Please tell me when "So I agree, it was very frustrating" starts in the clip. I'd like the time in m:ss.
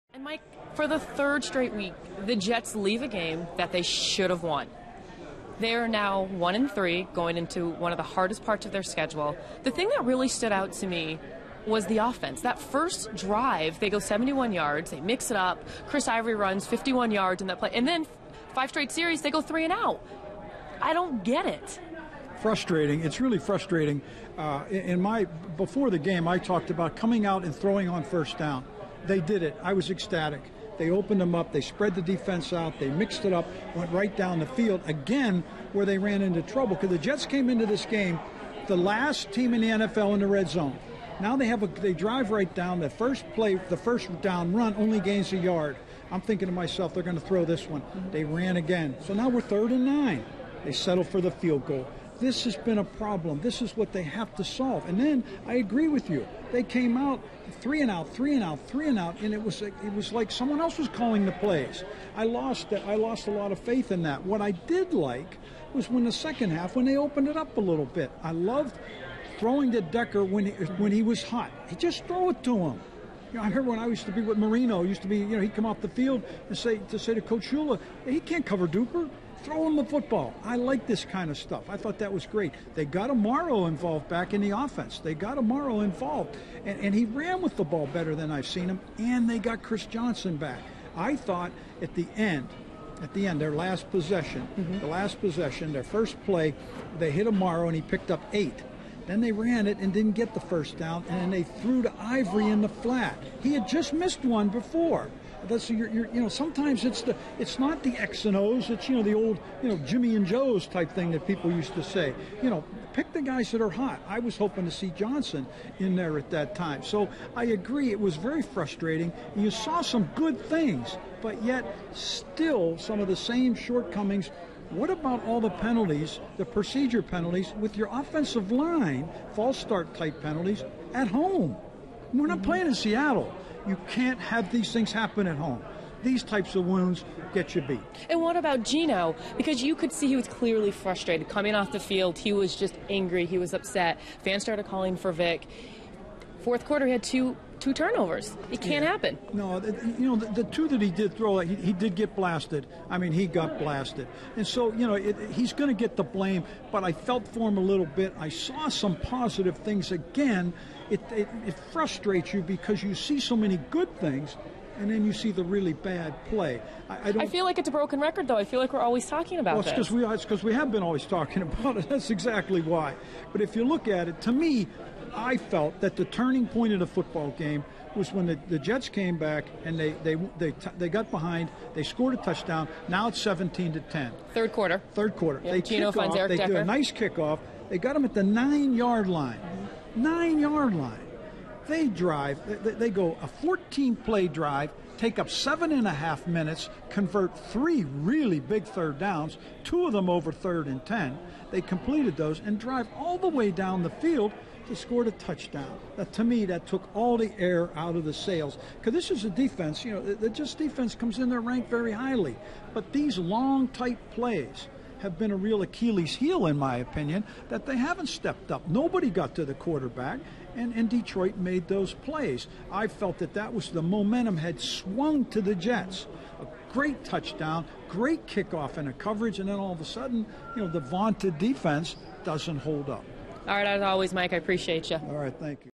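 1:56.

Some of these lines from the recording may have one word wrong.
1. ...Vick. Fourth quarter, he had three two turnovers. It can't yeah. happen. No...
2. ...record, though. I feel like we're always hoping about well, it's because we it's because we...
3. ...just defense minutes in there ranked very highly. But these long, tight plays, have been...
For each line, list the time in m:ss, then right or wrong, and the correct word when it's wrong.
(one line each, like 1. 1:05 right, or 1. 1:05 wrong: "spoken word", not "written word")
1. 2:25 wrong: "two", not "three"
2. 2:47 wrong: "talking", not "hoping"
3. 3:30 wrong: "comes", not "minutes".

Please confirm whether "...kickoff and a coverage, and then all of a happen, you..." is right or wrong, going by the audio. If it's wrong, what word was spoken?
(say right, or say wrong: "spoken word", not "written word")
wrong: "sudden", not "happen".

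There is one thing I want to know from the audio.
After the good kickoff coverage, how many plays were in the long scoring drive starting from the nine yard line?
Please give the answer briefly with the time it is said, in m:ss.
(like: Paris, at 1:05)
14, at 3:13.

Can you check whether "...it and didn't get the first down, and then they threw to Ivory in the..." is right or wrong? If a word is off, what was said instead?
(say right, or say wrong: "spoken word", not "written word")
right.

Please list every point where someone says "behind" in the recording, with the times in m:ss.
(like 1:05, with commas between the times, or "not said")
3:01.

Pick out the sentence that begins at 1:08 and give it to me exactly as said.
I loved throwing to Decker when he, when he was hot.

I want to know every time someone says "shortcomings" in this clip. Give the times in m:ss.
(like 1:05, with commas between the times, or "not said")
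2:03.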